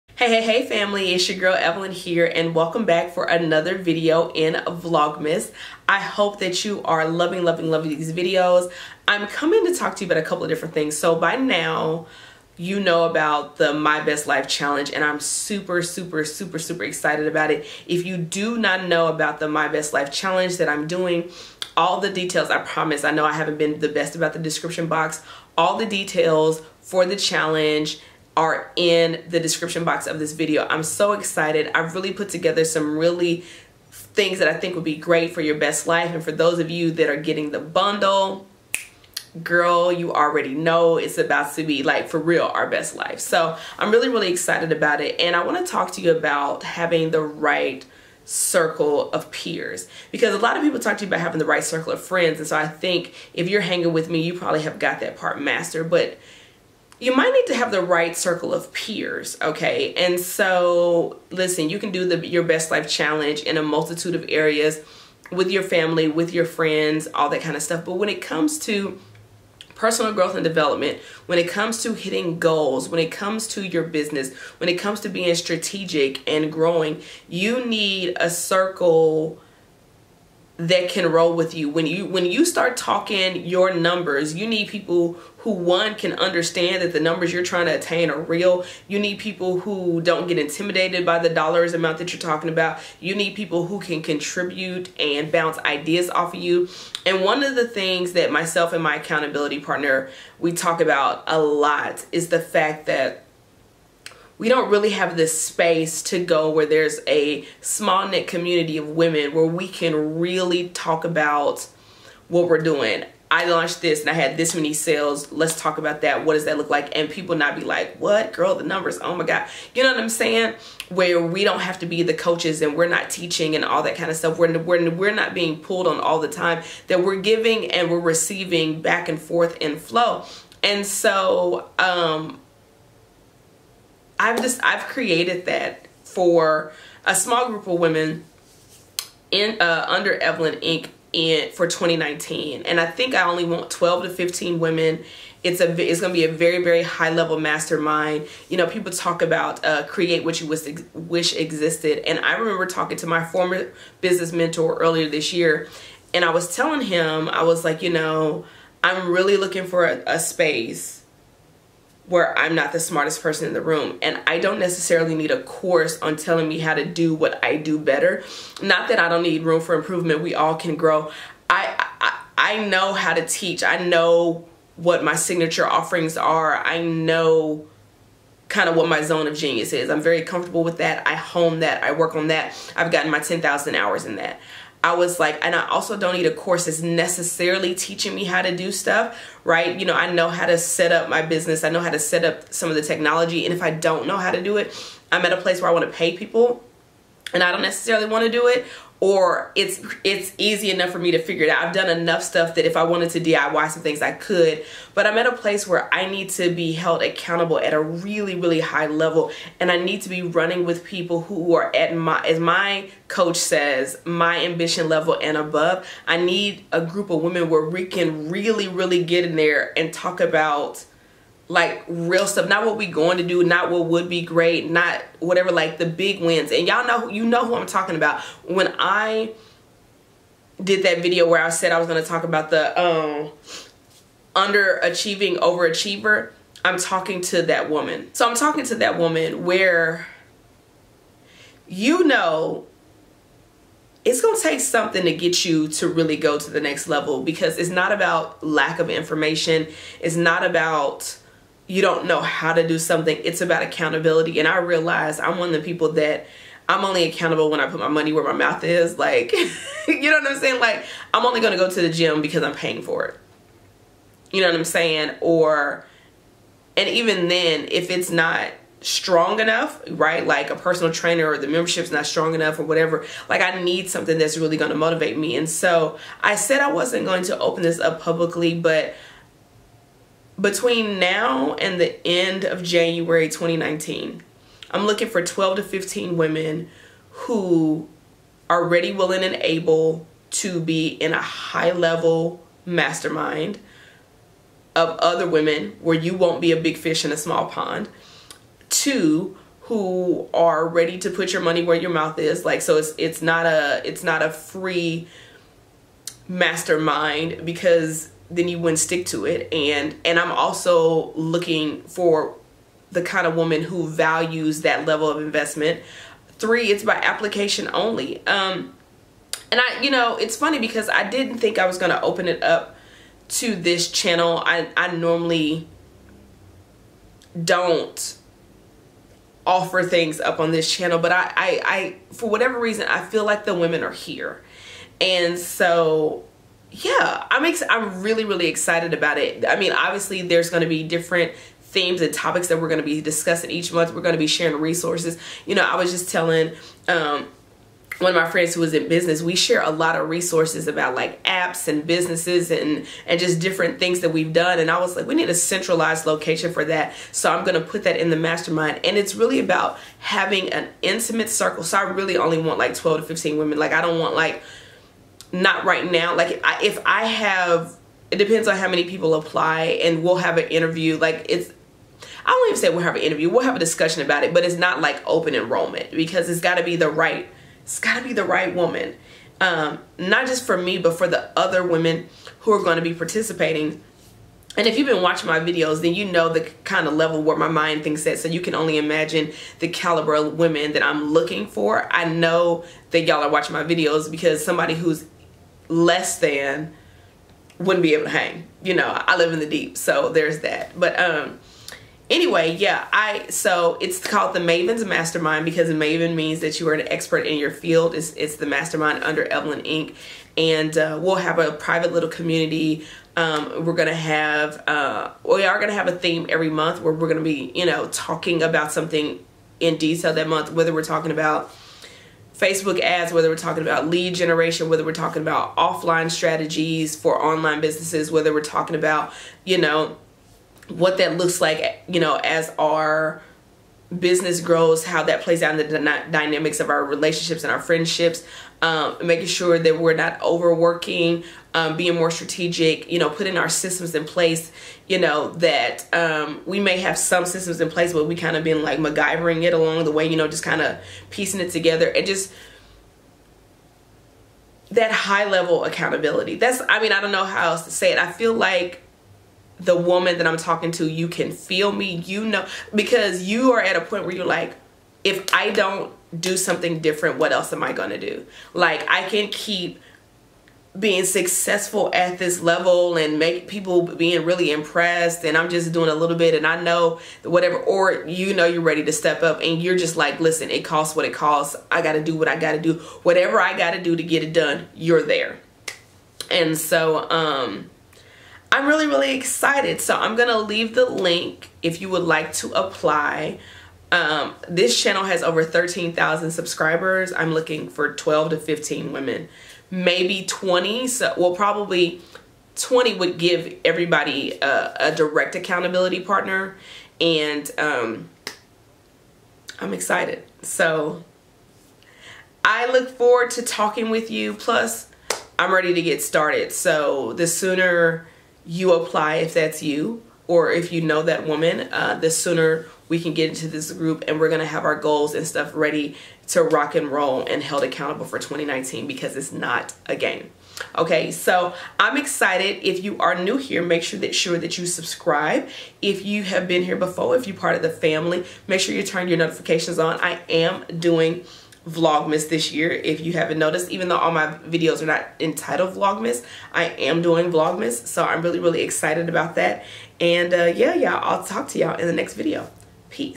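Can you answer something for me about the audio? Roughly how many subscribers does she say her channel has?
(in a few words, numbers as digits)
13,000.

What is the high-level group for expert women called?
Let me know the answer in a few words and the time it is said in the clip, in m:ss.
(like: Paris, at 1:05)
Maven's Mastermind, at 6:44.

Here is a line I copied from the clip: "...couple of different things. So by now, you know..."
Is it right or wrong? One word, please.
right.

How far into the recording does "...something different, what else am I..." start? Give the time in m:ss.
7:46.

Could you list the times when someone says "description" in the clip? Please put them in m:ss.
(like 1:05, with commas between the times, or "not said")
0:24, 0:29.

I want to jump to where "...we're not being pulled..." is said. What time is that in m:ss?
2:04.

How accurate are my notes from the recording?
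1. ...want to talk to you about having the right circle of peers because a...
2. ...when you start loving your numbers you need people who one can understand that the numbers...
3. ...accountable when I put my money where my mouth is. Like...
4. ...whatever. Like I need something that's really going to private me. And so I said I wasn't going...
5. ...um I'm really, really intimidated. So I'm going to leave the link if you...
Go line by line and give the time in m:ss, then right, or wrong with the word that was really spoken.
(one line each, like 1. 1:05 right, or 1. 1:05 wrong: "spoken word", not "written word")
1. 0:45 right
2. 1:22 wrong: "talking", not "loving"
3. 4:17 right
4. 4:32 wrong: "motivate", not "private"
5. 8:07 wrong: "excited", not "intimidated".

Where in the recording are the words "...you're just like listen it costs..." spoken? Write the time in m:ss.
7:59.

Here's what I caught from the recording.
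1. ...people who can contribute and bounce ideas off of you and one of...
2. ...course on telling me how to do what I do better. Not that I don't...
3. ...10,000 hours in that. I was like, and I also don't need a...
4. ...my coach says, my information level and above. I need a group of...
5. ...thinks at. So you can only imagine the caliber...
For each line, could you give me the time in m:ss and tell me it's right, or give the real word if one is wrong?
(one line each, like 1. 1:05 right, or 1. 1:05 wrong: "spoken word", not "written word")
1. 1:33 right
2. 2:45 right
3. 3:03 right
4. 3:32 wrong: "ambition", not "information"
5. 6:27 right.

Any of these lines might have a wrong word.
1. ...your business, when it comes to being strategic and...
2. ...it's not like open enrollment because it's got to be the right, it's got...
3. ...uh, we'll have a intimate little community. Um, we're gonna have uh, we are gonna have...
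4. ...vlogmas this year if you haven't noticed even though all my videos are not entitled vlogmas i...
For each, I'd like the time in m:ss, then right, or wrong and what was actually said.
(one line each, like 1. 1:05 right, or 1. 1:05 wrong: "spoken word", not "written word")
1. 1:13 right
2. 6:14 right
3. 6:50 wrong: "private", not "intimate"
4. 9:01 right.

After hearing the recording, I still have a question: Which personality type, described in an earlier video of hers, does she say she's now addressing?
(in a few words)
underachieving overachiever.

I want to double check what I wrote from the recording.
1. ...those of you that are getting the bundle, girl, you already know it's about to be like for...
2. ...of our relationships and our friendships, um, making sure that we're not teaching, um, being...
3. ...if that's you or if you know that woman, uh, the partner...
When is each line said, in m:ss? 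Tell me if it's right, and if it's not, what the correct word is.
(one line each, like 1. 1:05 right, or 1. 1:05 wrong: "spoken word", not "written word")
1. 0:36 right
2. 7:16 wrong: "overworking", not "teaching"
3. 8:39 wrong: "sooner", not "partner".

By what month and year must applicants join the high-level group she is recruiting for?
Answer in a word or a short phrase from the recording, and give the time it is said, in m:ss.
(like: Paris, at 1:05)
January 2019, at 4:42.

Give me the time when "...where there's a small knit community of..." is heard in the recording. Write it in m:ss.
1:46.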